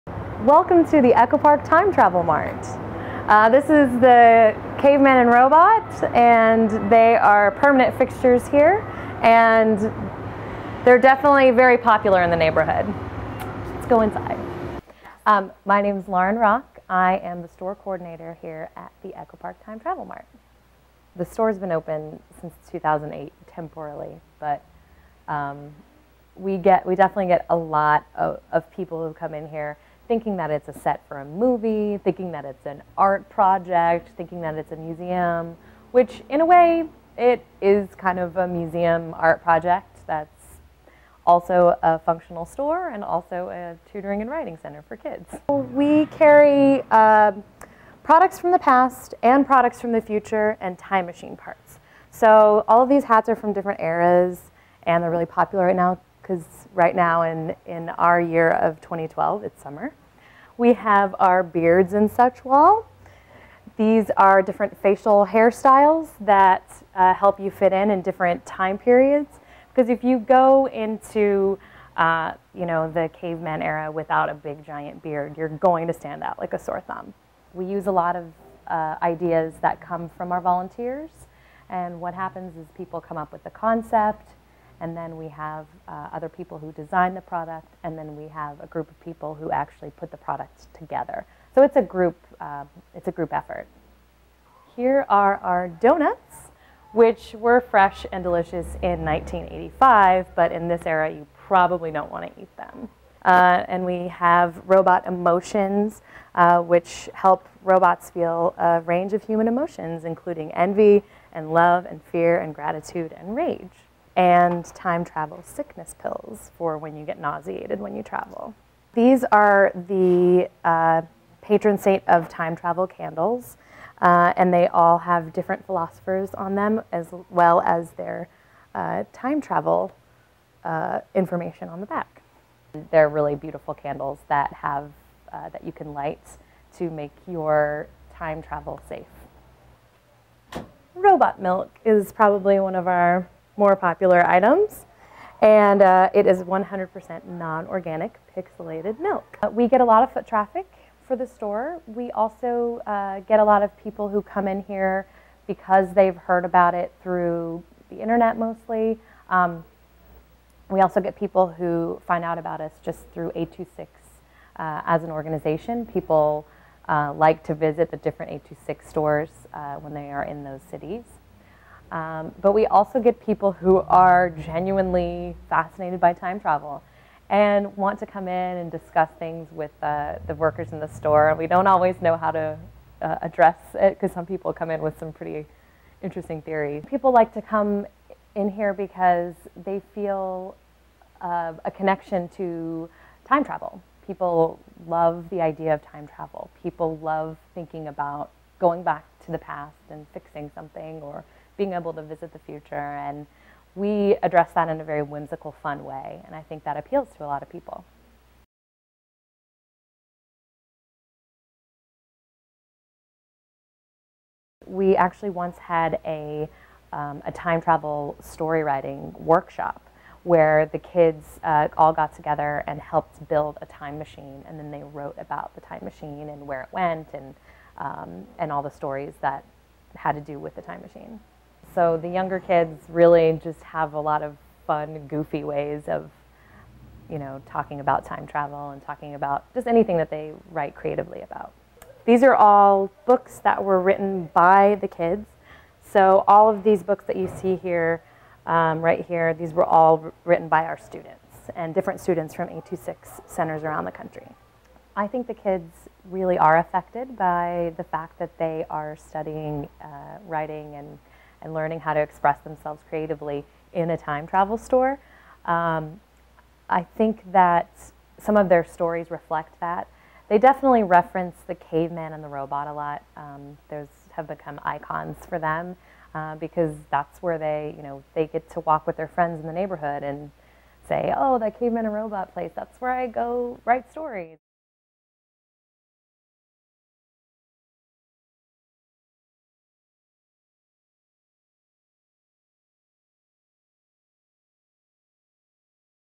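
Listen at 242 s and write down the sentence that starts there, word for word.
These are all books that were written by the kids.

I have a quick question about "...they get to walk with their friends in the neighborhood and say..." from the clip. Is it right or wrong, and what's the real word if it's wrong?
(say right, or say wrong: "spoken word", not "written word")
right.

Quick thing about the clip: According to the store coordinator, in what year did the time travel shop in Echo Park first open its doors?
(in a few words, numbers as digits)
2008.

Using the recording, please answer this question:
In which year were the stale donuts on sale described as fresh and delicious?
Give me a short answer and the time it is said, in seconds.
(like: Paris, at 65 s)
1985, at 99 s.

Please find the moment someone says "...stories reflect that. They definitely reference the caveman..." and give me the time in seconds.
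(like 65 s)
268 s.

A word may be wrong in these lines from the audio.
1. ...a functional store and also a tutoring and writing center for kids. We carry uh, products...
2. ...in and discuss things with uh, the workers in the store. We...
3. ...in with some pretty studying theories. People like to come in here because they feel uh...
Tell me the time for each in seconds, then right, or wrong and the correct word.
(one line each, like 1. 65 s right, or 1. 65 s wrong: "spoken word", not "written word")
1. 41 s right
2. 178 s right
3. 184 s wrong: "interesting", not "studying".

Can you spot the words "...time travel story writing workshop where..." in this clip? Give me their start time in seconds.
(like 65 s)
217 s.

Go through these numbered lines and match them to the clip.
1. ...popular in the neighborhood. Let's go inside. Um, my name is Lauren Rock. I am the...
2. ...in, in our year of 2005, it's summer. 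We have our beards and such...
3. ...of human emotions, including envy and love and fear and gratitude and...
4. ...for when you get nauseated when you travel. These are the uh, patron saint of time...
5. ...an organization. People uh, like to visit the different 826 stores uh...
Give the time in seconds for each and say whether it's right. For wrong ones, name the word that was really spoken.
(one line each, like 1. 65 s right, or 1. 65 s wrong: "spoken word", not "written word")
1. 11 s right
2. 57 s wrong: "2012", not "2005"
3. 109 s right
4. 116 s right
5. 165 s right.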